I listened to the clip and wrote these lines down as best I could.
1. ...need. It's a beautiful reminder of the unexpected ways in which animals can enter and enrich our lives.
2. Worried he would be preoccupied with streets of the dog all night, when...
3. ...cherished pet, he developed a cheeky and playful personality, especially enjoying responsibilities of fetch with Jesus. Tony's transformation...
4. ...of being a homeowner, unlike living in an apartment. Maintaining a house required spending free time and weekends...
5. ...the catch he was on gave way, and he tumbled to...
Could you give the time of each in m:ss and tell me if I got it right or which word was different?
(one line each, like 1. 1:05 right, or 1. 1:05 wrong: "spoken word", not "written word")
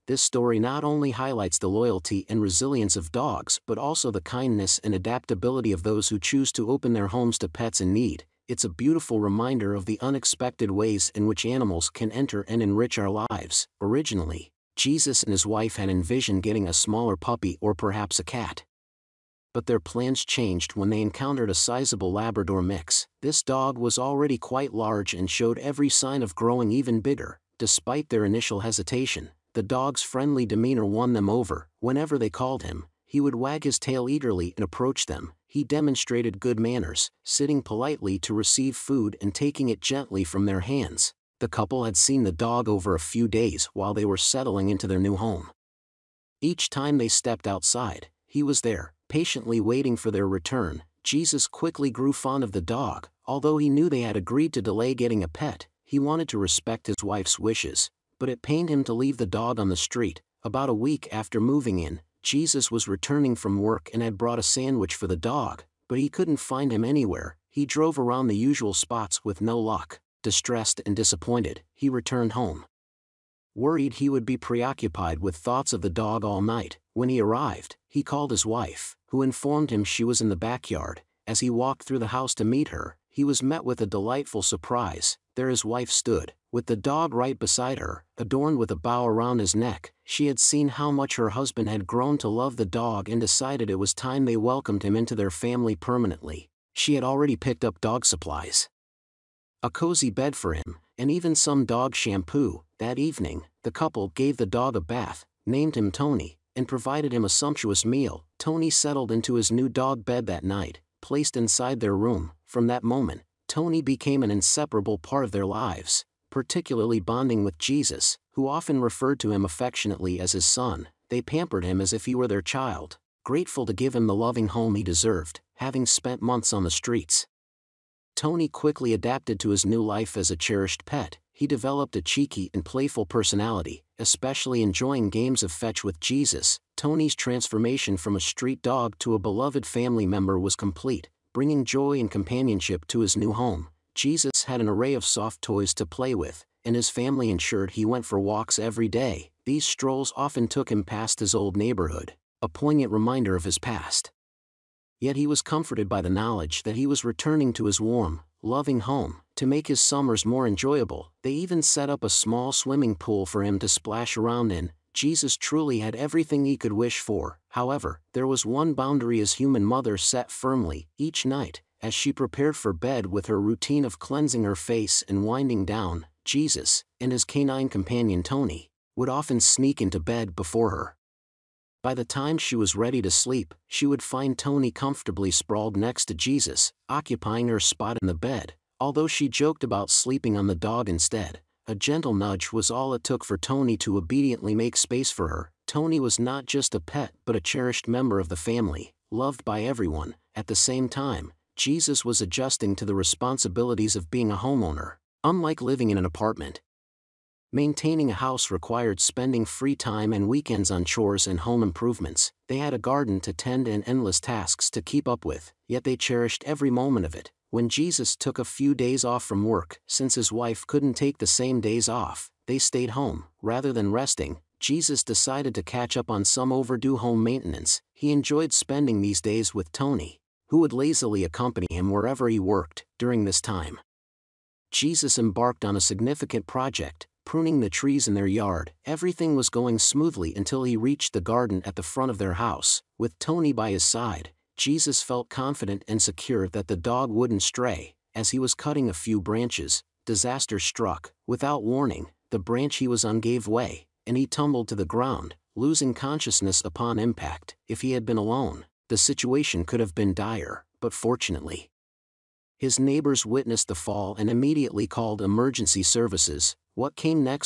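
1. 0:07 right
2. 1:13 wrong: "thoughts", not "streets"
3. 2:10 wrong: "games", not "responsibilities"
4. 3:23 right
5. 4:12 wrong: "branch", not "catch".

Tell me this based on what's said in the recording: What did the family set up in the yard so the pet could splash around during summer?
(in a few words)
small swimming pool.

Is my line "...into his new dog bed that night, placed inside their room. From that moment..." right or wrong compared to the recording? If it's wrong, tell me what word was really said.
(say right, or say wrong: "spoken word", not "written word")
right.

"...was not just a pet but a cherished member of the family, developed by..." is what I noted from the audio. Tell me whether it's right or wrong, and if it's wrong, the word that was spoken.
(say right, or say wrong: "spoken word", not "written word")
wrong: "loved", not "developed".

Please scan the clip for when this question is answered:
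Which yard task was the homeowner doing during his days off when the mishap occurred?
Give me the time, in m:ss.
3:57.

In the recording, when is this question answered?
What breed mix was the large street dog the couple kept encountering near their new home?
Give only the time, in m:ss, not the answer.
0:22.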